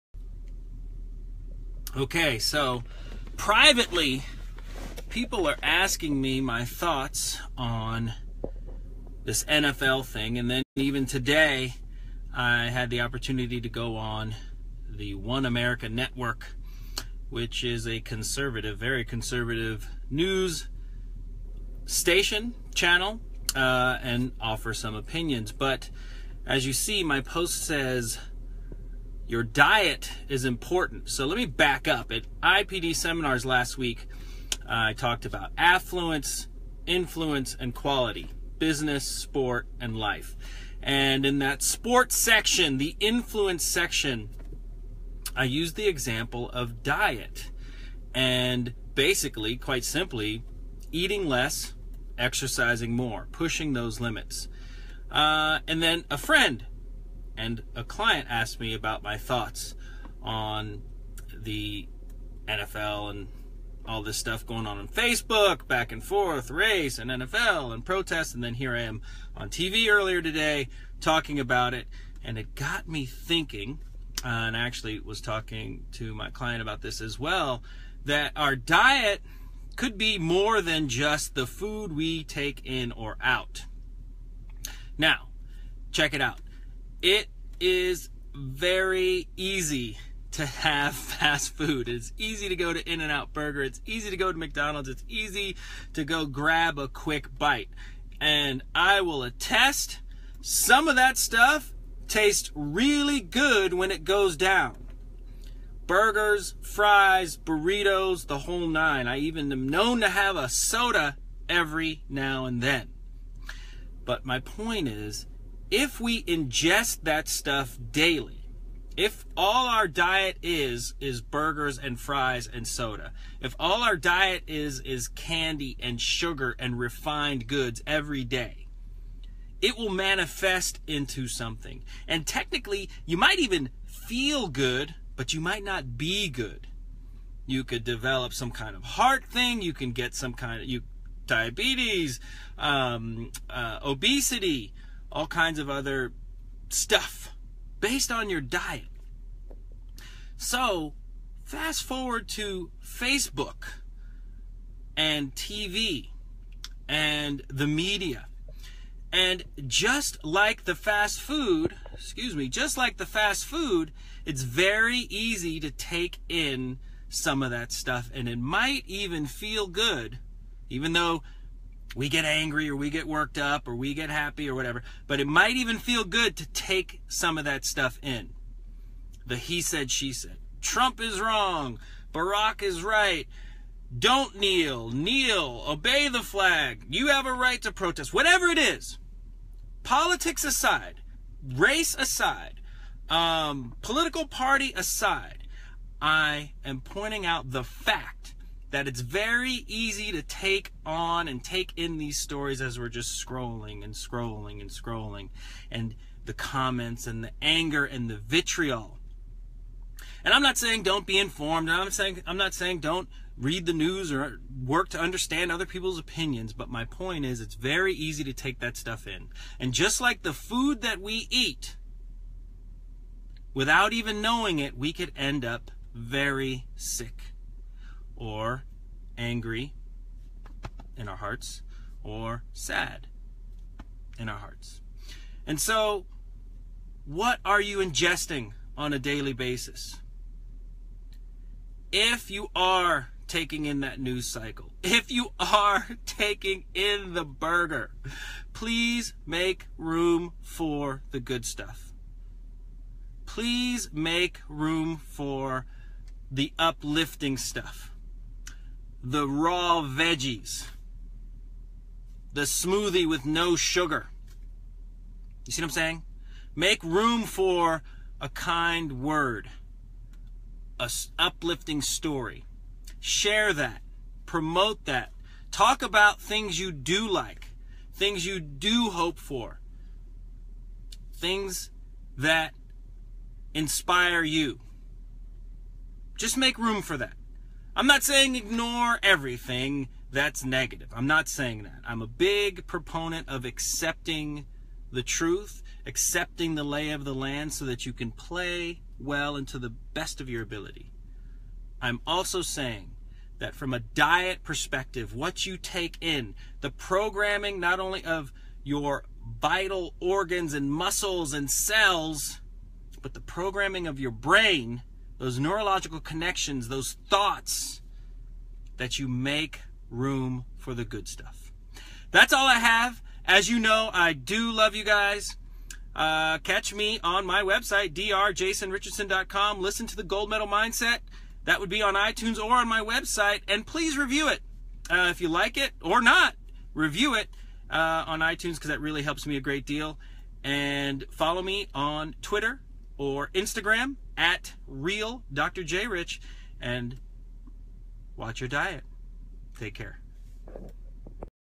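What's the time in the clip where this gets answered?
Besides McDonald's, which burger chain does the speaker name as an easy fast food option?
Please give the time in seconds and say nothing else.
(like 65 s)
92 s.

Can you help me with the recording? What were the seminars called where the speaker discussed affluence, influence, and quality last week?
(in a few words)
IPD.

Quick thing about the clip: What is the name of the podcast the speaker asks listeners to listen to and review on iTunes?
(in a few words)
Gold Medal Mindset.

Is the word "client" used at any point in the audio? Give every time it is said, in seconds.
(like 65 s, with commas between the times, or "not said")
57 s, 76 s.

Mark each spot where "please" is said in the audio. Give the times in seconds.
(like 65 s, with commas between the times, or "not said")
248 s, 253 s, 333 s.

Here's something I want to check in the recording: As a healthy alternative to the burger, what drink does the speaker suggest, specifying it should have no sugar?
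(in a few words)
smoothie.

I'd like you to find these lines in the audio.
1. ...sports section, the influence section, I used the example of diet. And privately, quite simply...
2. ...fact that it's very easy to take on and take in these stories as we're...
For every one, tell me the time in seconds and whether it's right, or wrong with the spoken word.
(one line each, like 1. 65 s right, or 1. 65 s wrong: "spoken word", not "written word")
1. 41 s wrong: "basically", not "privately"
2. 197 s right.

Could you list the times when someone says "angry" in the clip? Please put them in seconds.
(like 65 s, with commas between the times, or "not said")
172 s, 229 s.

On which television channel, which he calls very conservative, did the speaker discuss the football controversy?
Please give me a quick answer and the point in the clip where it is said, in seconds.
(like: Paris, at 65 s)
One America Network, at 15 s.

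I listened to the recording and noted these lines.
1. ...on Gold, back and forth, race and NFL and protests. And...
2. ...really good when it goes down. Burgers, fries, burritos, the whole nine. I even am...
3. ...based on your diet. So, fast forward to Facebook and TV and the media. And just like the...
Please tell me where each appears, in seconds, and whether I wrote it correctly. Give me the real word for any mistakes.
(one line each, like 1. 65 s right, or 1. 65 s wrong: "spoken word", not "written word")
1. 64 s wrong: "Facebook", not "Gold"
2. 102 s right
3. 147 s right.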